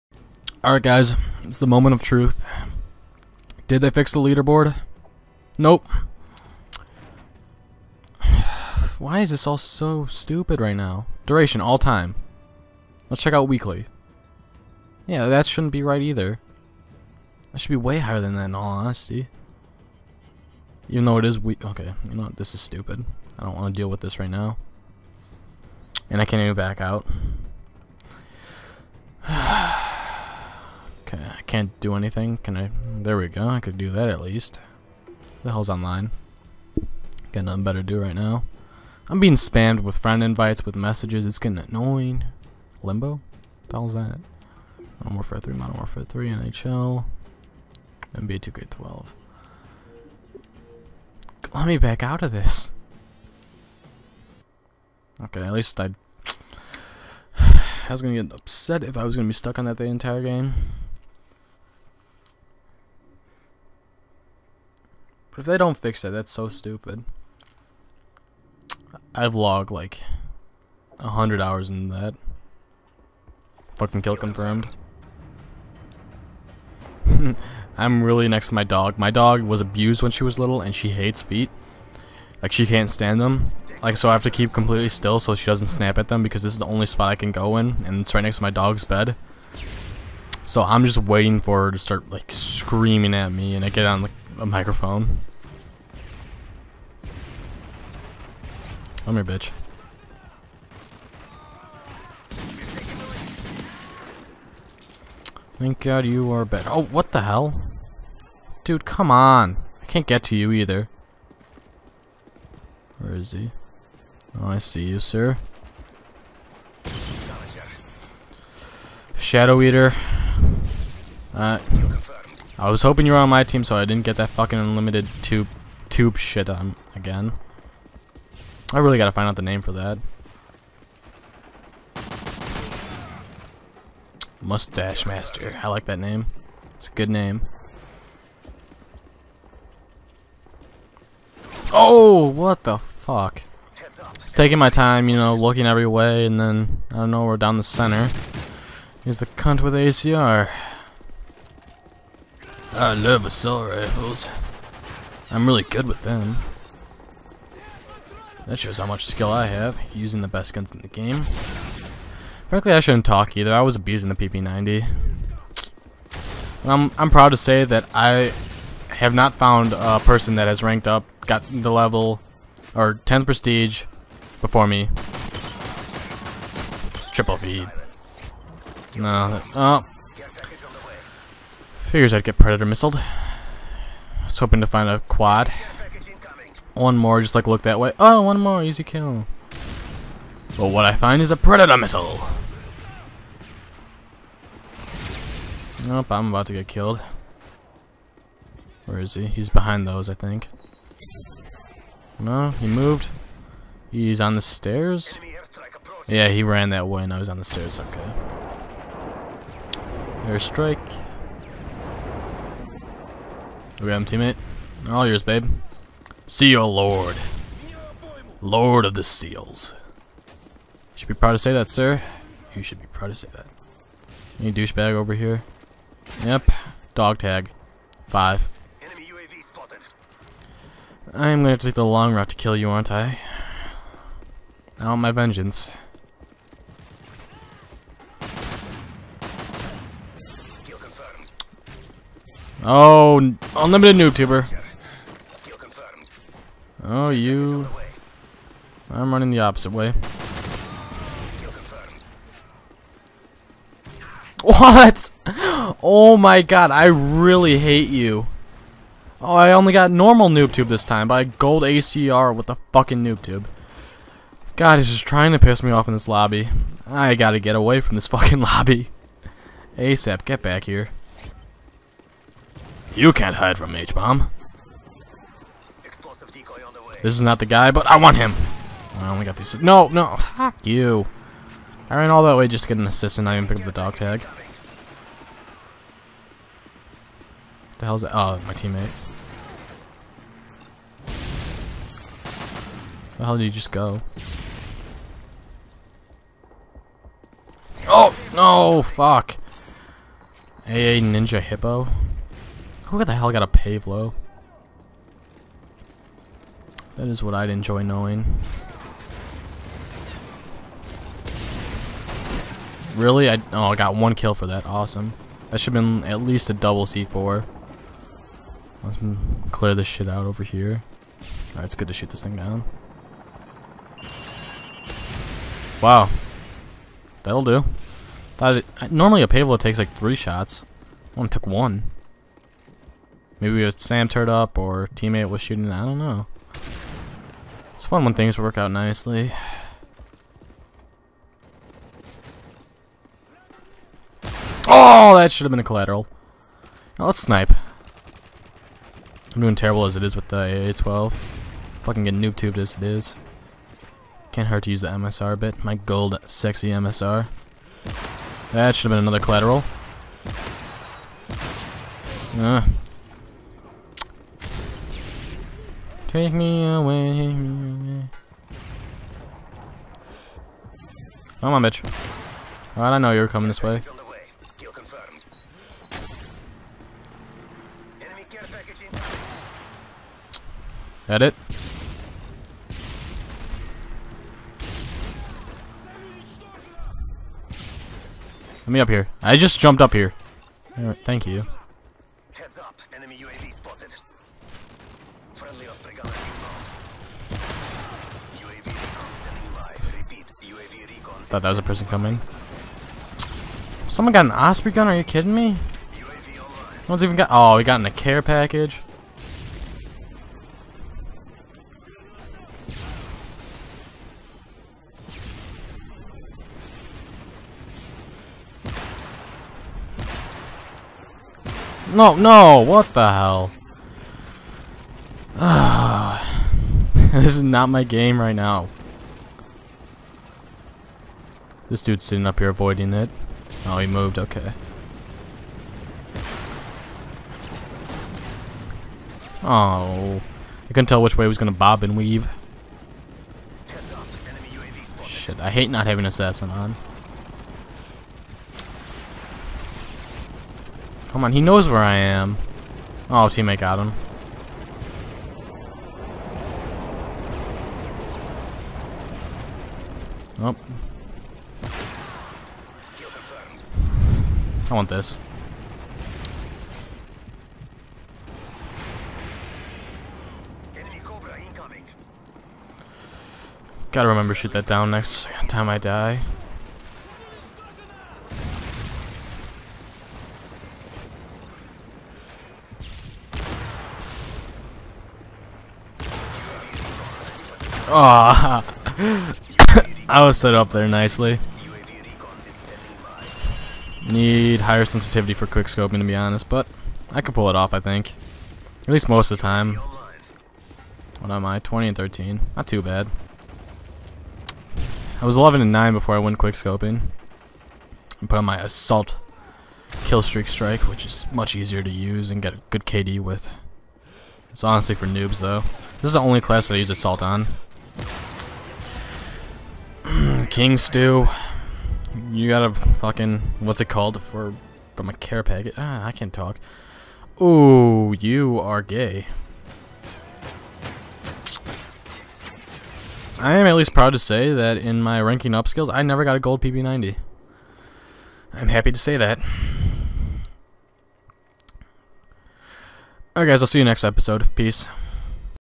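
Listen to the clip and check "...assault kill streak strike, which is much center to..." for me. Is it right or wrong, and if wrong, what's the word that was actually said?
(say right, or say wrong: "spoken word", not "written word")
wrong: "easier", not "center".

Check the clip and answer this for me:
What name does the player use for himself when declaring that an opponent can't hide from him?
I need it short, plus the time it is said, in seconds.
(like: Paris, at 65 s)
H-Bomb, at 273 s.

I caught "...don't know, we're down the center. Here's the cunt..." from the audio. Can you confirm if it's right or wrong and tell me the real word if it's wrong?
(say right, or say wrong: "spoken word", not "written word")
right.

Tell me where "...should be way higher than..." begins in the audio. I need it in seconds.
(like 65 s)
17 s.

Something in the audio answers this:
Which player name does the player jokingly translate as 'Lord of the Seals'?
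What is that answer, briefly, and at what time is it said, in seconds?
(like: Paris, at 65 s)
Seal Lord, at 216 s.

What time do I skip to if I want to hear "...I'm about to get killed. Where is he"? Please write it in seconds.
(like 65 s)
196 s.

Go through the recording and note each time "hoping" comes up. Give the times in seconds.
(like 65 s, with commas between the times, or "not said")
122 s, 184 s.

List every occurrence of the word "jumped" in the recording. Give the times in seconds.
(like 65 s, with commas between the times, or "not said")
389 s.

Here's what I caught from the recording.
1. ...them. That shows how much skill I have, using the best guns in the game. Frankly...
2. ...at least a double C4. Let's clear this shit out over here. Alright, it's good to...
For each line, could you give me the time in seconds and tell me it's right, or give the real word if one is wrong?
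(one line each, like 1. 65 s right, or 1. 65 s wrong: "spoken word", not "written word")
1. 156 s right
2. 316 s right.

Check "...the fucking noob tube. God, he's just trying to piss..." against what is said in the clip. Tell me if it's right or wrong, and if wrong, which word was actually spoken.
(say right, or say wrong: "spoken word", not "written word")
right.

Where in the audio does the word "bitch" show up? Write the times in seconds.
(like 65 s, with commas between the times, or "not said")
99 s, 371 s.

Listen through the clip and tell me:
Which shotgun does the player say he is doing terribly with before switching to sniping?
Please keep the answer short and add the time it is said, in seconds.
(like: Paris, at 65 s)
AA-12, at 350 s.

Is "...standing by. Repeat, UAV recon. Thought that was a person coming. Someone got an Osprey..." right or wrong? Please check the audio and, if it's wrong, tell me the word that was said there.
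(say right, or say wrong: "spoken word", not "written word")
right.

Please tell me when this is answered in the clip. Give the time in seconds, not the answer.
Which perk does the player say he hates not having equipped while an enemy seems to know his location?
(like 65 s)
446 s.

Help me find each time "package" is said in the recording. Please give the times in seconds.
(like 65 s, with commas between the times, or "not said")
408 s, 525 s.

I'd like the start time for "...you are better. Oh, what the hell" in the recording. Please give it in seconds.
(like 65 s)
106 s.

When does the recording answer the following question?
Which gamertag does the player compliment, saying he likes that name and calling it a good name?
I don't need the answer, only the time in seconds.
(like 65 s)
134 s.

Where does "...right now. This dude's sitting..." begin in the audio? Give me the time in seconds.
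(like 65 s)
428 s.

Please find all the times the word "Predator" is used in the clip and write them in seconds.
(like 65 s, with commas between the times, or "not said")
182 s, 191 s.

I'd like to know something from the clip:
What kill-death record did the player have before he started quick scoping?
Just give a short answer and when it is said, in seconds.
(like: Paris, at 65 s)
11 and 9, at 505 s.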